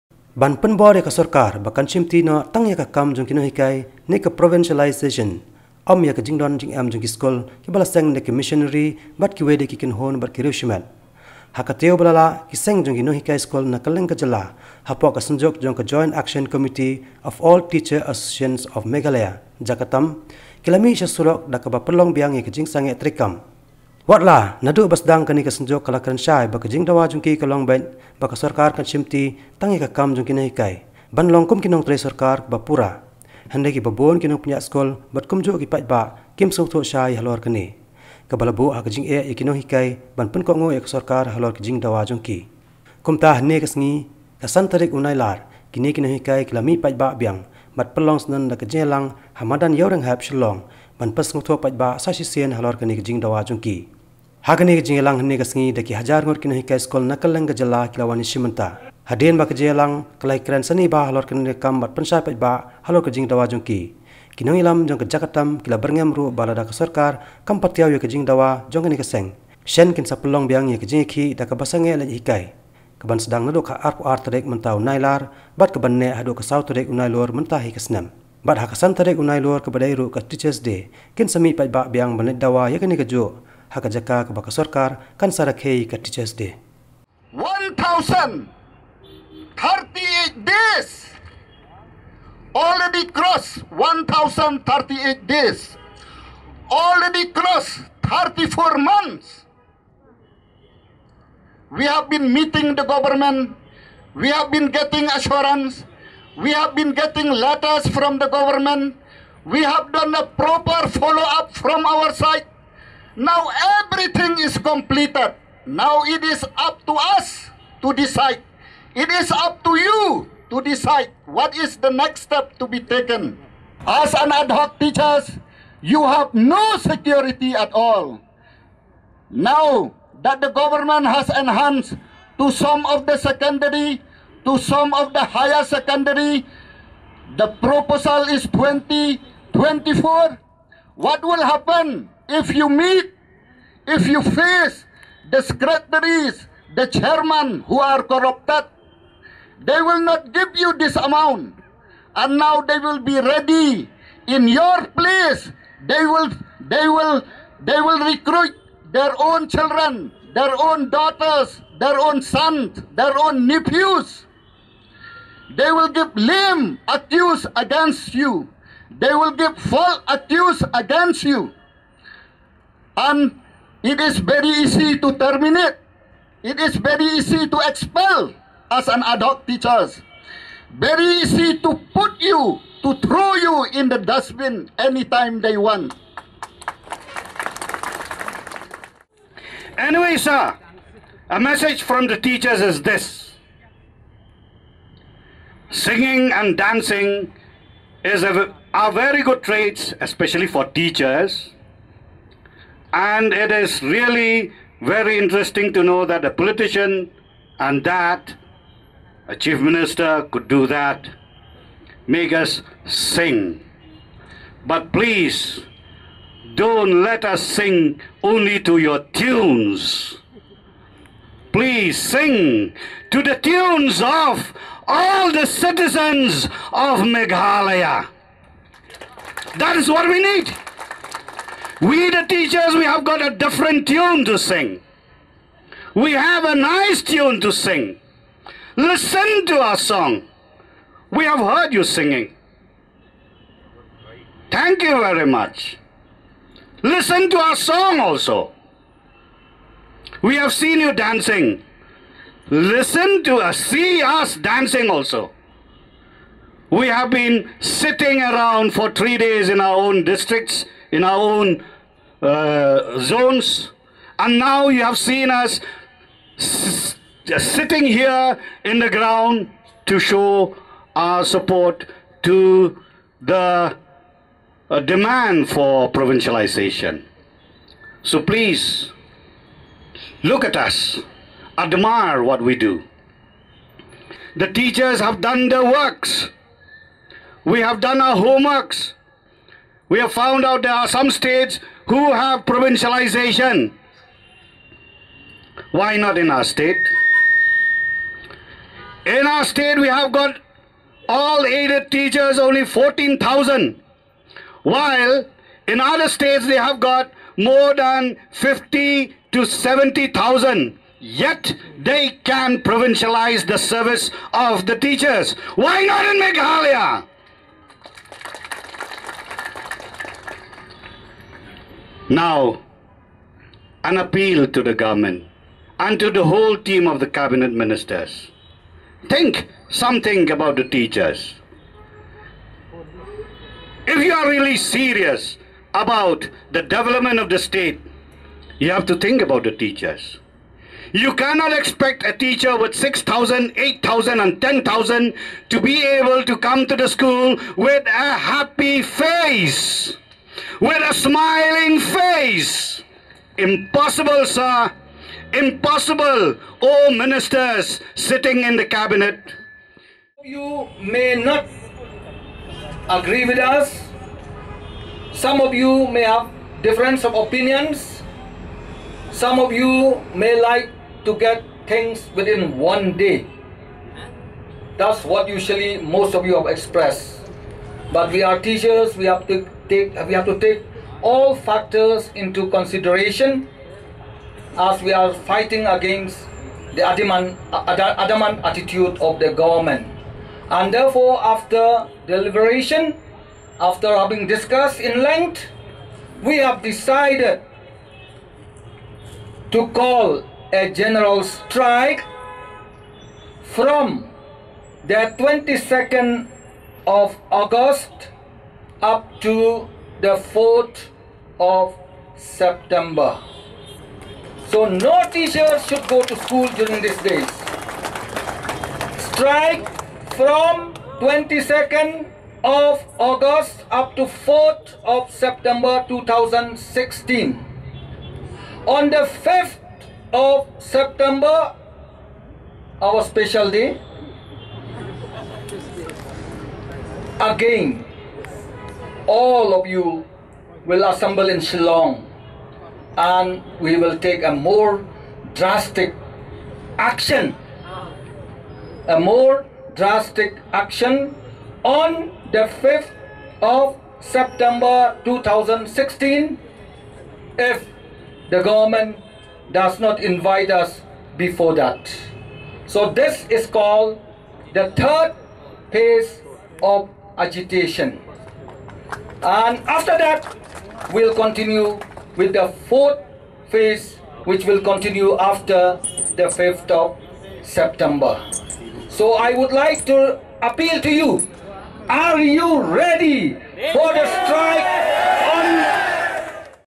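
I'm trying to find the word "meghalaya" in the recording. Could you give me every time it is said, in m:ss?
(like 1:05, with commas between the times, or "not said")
0:18, 3:47, 5:16.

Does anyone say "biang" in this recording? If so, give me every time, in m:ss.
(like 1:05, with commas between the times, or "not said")
0:22, 0:47, 1:10, 1:21.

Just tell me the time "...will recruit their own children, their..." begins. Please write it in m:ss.
2:37.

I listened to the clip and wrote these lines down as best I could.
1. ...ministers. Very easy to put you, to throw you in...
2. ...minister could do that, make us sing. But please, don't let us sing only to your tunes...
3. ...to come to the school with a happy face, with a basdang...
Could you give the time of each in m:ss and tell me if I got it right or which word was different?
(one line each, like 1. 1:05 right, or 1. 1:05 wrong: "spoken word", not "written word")
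1. 2:59 wrong: "teachers", not "ministers"
2. 3:29 right
3. 5:46 wrong: "smiling", not "basdang".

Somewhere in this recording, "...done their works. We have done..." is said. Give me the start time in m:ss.
4:45.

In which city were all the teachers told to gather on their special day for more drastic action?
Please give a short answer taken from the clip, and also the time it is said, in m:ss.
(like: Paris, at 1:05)
Shillong, at 7:21.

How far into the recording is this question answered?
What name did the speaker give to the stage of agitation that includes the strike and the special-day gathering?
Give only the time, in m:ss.
7:44.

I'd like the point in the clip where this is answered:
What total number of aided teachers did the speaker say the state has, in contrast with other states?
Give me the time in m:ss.
5:02.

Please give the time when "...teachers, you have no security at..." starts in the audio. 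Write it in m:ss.
2:04.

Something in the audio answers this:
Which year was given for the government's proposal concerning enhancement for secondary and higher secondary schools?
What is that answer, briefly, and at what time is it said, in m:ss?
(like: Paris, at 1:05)
2024, at 2:18.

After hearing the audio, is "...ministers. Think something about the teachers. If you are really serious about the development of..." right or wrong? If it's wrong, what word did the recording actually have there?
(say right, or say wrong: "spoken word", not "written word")
right.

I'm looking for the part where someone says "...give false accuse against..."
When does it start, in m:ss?
2:49.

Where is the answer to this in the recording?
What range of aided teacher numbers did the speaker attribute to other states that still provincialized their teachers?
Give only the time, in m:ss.
5:08.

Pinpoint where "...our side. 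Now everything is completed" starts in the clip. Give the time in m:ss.
1:51.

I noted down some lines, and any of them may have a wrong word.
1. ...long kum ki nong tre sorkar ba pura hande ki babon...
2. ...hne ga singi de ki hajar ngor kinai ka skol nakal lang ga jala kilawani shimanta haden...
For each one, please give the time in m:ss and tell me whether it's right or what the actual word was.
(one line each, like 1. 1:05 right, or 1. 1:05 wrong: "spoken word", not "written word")
1. 0:31 wrong: "sarkar", not "sorkar"
2. 0:55 right.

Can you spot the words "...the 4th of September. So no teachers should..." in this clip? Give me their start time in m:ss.
6:49.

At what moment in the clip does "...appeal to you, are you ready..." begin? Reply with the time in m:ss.
8:00.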